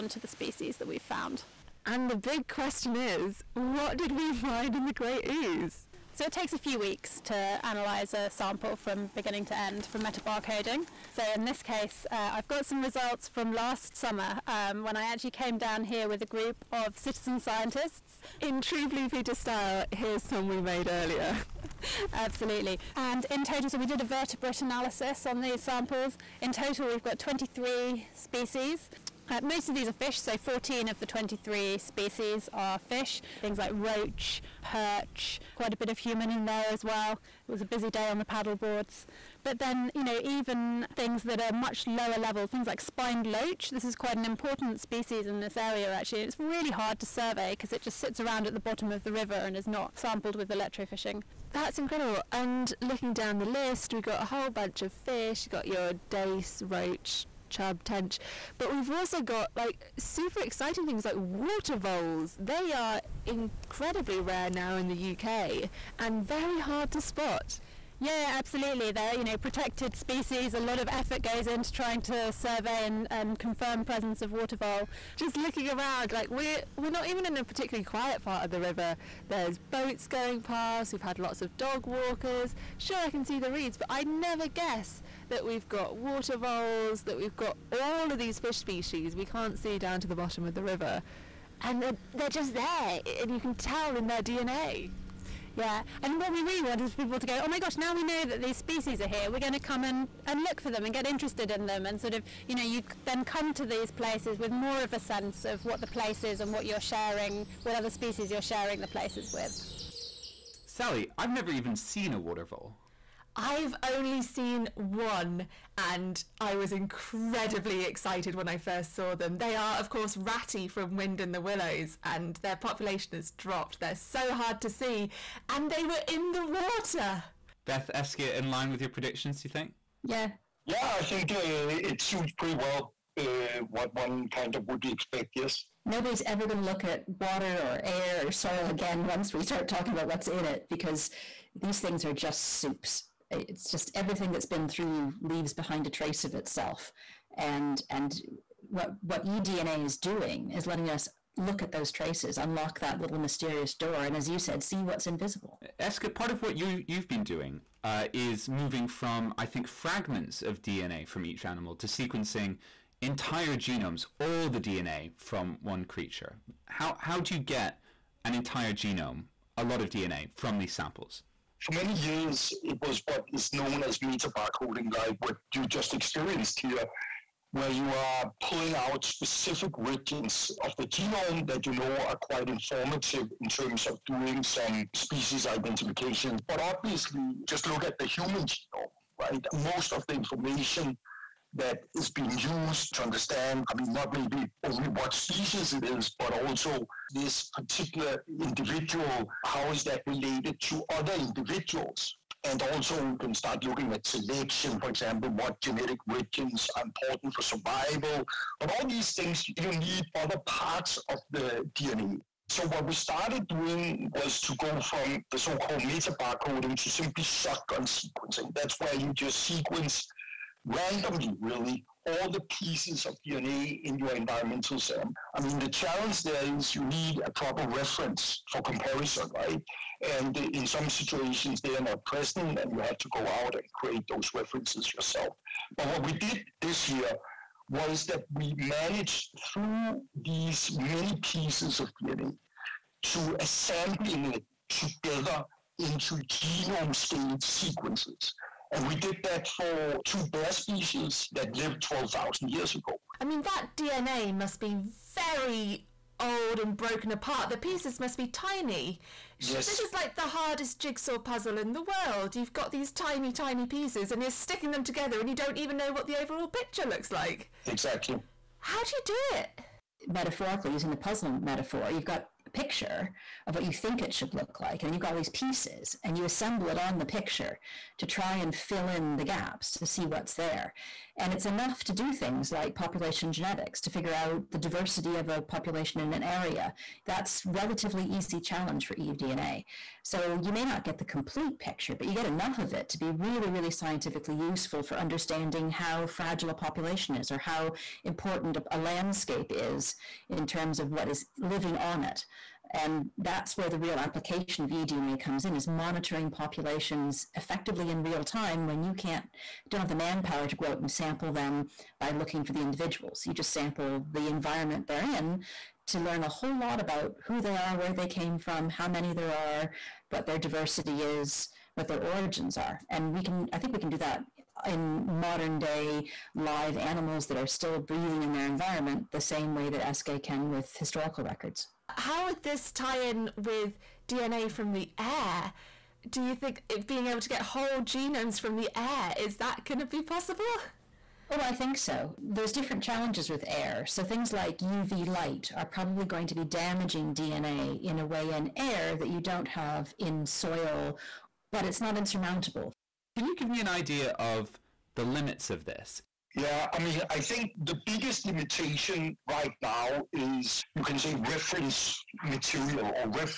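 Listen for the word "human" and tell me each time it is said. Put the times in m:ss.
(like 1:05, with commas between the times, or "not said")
0:35, 3:08.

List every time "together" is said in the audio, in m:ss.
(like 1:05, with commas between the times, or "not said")
4:04, 4:24.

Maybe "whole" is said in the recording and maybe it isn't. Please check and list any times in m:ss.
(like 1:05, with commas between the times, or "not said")
0:54, 5:16, 5:37.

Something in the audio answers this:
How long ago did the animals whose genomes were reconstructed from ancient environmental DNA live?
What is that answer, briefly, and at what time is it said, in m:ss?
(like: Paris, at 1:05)
12,000 years ago, at 4:11.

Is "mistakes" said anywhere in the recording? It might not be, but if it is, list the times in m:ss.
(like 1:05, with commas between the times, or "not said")
not said.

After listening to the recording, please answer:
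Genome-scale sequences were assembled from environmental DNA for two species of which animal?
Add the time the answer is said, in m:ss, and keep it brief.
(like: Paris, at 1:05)
Bear, at 4:10.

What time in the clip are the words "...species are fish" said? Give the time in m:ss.
0:31.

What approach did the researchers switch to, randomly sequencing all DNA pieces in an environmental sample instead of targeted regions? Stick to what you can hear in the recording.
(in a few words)
Shotgun sequencing.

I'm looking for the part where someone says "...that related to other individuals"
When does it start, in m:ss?
3:19.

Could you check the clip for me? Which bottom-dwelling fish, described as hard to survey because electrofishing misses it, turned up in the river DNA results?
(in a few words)
Spined loach.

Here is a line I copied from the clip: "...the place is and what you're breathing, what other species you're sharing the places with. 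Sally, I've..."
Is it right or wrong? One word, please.
wrong.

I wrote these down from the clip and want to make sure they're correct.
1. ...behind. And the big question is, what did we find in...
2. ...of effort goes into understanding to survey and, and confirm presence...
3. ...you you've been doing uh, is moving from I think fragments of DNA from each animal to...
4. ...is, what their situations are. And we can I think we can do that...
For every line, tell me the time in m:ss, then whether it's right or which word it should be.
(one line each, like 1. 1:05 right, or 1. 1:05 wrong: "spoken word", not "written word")
1. 0:01 wrong: "found", not "behind"
2. 1:10 wrong: "trying", not "understanding"
3. 2:36 right
4. 5:21 wrong: "origins", not "situations".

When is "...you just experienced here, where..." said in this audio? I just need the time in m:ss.
2:55.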